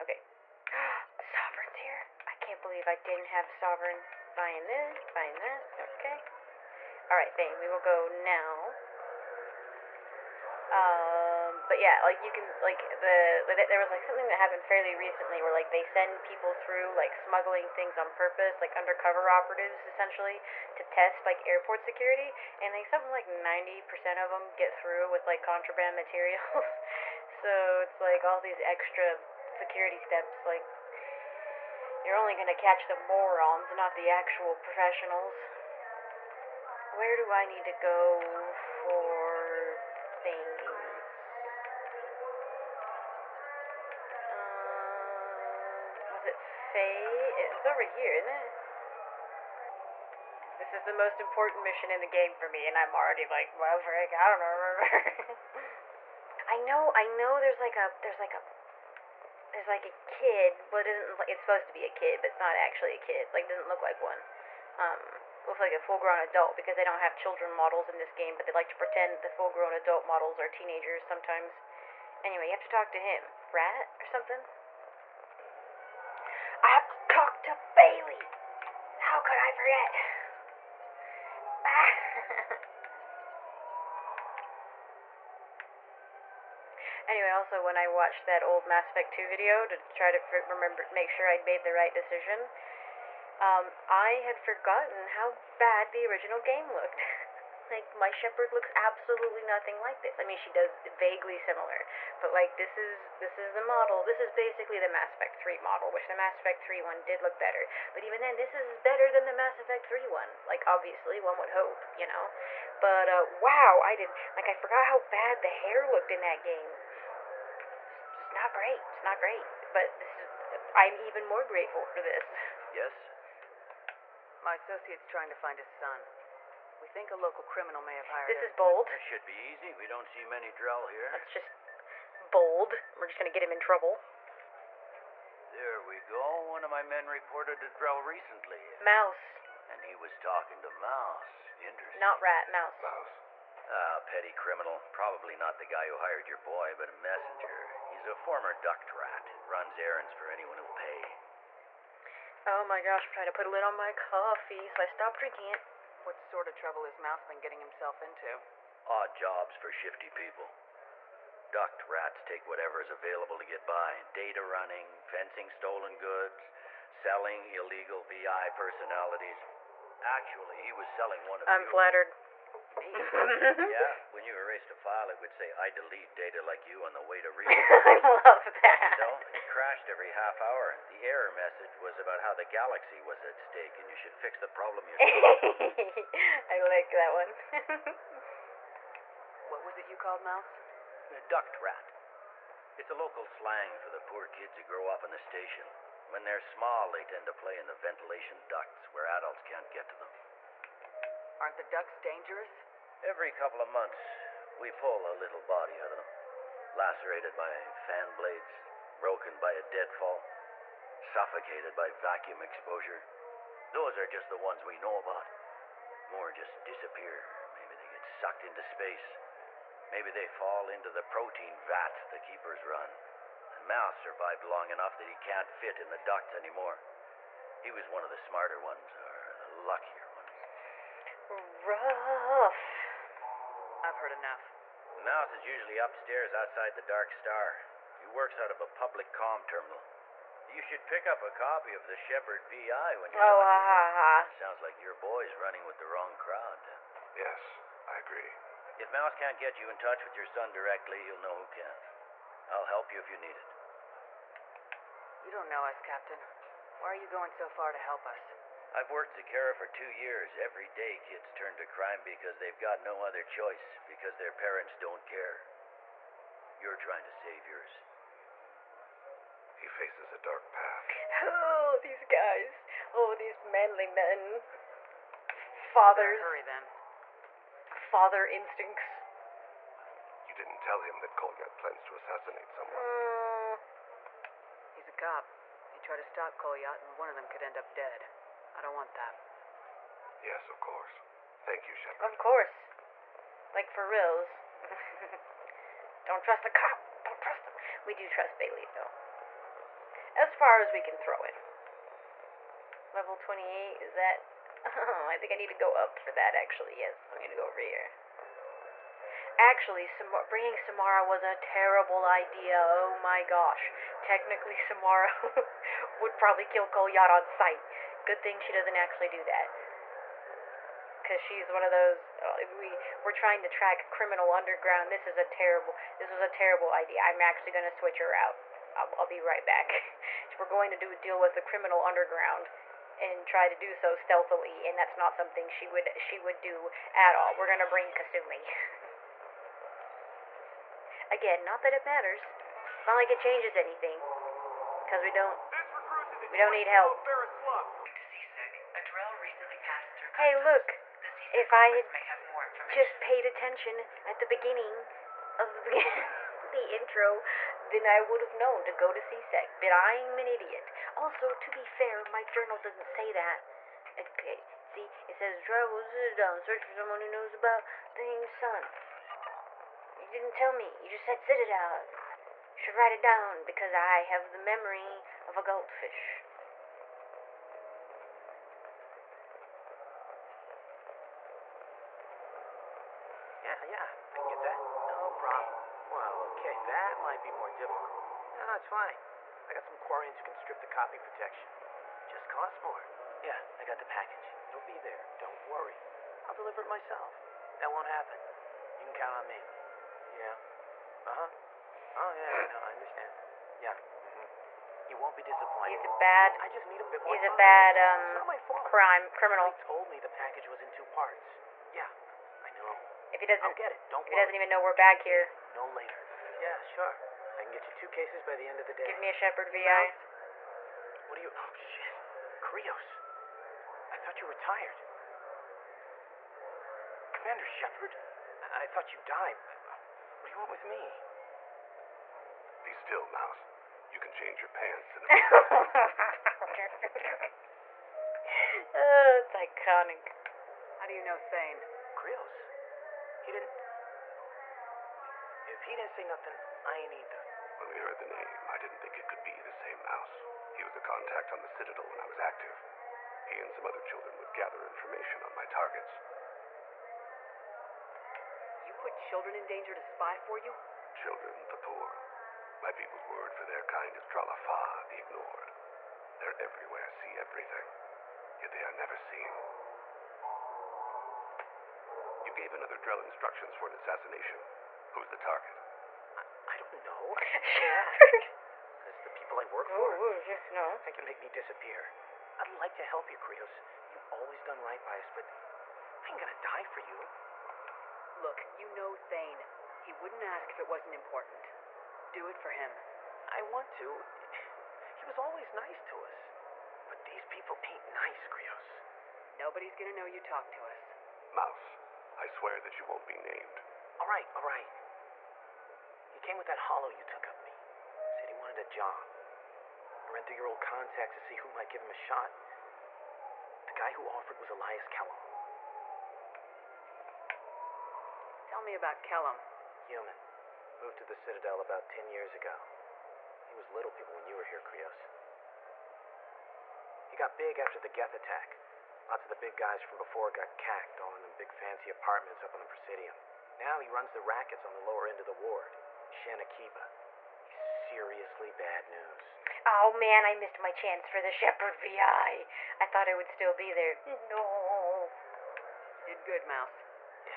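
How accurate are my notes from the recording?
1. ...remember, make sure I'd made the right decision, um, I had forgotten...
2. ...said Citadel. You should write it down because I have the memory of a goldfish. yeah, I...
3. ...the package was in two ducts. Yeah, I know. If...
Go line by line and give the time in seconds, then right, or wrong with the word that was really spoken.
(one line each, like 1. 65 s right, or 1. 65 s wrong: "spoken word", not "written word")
1. 90 s right
2. 371 s right
3. 409 s wrong: "parts", not "ducts".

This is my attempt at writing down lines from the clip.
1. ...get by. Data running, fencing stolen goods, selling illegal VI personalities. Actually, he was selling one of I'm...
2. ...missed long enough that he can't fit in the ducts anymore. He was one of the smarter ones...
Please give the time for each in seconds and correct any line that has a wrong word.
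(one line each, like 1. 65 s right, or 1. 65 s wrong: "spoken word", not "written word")
1. 163 s right
2. 223 s wrong: "survived", not "missed".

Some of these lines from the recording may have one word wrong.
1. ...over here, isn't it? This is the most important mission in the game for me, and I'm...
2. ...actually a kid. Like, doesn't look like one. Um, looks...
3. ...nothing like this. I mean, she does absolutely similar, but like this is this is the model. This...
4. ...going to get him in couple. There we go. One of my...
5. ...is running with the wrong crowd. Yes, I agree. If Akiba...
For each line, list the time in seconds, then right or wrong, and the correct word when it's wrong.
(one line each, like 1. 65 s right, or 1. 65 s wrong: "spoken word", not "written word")
1. 47 s right
2. 62 s right
3. 99 s wrong: "vaguely", not "absolutely"
4. 133 s wrong: "trouble", not "couple"
5. 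245 s wrong: "Mouse", not "Akiba".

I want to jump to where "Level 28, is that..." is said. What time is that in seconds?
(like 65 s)
302 s.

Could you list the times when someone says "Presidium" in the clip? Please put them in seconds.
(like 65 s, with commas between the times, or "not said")
532 s.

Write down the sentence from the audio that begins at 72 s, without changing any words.
Anyway, you have to talk to him, Rat or something.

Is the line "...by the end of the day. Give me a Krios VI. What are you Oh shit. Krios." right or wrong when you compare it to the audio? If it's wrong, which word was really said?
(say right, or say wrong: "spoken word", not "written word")
wrong: "Shepard", not "Krios".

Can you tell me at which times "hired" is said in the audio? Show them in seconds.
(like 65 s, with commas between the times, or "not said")
128 s, 145 s.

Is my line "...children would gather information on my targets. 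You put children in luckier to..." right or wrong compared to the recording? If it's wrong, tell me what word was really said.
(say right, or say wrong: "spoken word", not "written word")
wrong: "danger", not "luckier".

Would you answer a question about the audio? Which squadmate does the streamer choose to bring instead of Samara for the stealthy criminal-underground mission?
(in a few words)
Kasumi.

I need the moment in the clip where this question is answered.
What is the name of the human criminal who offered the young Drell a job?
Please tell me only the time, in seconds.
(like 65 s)
514 s.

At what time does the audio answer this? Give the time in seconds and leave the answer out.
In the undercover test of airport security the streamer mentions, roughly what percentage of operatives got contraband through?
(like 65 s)
23 s.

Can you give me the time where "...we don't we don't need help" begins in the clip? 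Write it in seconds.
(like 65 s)
345 s.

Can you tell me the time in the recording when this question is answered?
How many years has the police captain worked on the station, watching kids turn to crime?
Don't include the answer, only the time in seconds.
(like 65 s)
259 s.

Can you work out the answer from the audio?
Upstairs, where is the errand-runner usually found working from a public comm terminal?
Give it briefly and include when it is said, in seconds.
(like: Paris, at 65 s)
outside the Dark Star, at 236 s.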